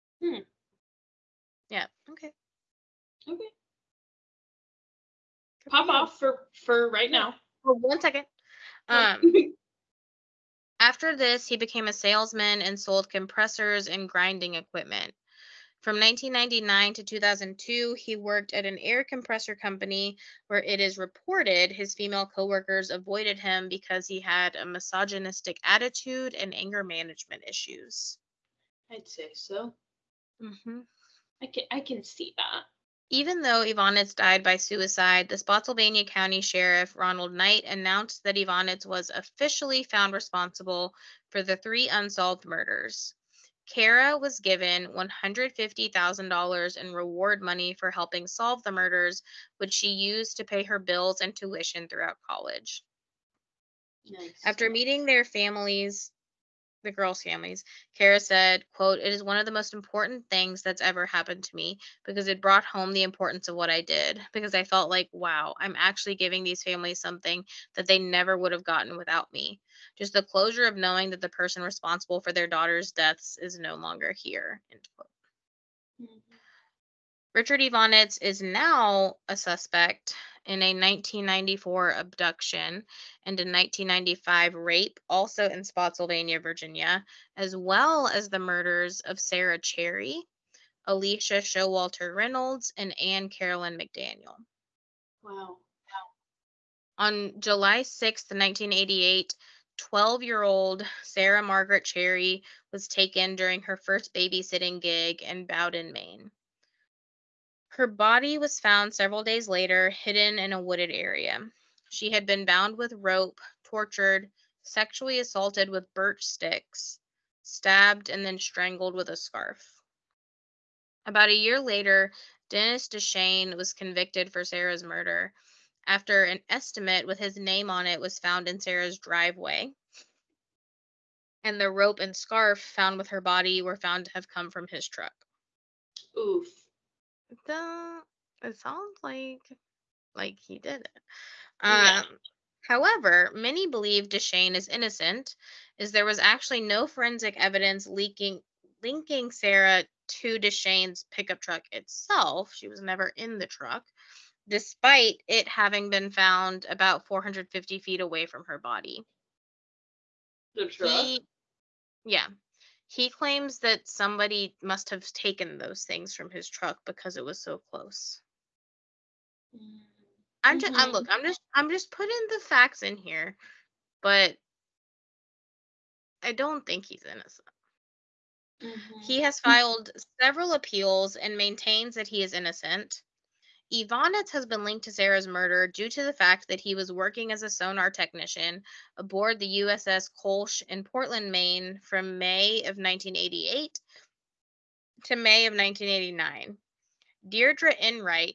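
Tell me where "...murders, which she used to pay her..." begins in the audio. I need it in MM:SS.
00:48.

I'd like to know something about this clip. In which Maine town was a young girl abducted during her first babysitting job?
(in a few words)
Bowdoin.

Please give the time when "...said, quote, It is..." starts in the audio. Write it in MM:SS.
00:58.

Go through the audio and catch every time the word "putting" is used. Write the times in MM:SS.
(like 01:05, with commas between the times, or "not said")
02:51.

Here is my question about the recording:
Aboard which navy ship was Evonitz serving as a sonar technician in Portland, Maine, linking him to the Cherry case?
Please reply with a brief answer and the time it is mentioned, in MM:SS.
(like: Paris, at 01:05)
USS Koelsch, at 03:09.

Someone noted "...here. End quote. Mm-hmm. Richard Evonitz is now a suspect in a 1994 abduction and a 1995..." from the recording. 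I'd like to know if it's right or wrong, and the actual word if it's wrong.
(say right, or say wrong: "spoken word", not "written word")
right.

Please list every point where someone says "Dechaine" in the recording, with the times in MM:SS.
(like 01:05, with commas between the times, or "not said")
02:02, 02:24, 02:30.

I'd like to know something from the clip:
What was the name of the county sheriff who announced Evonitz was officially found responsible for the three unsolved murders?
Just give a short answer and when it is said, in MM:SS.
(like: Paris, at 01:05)
Ronald Knight, at 00:36.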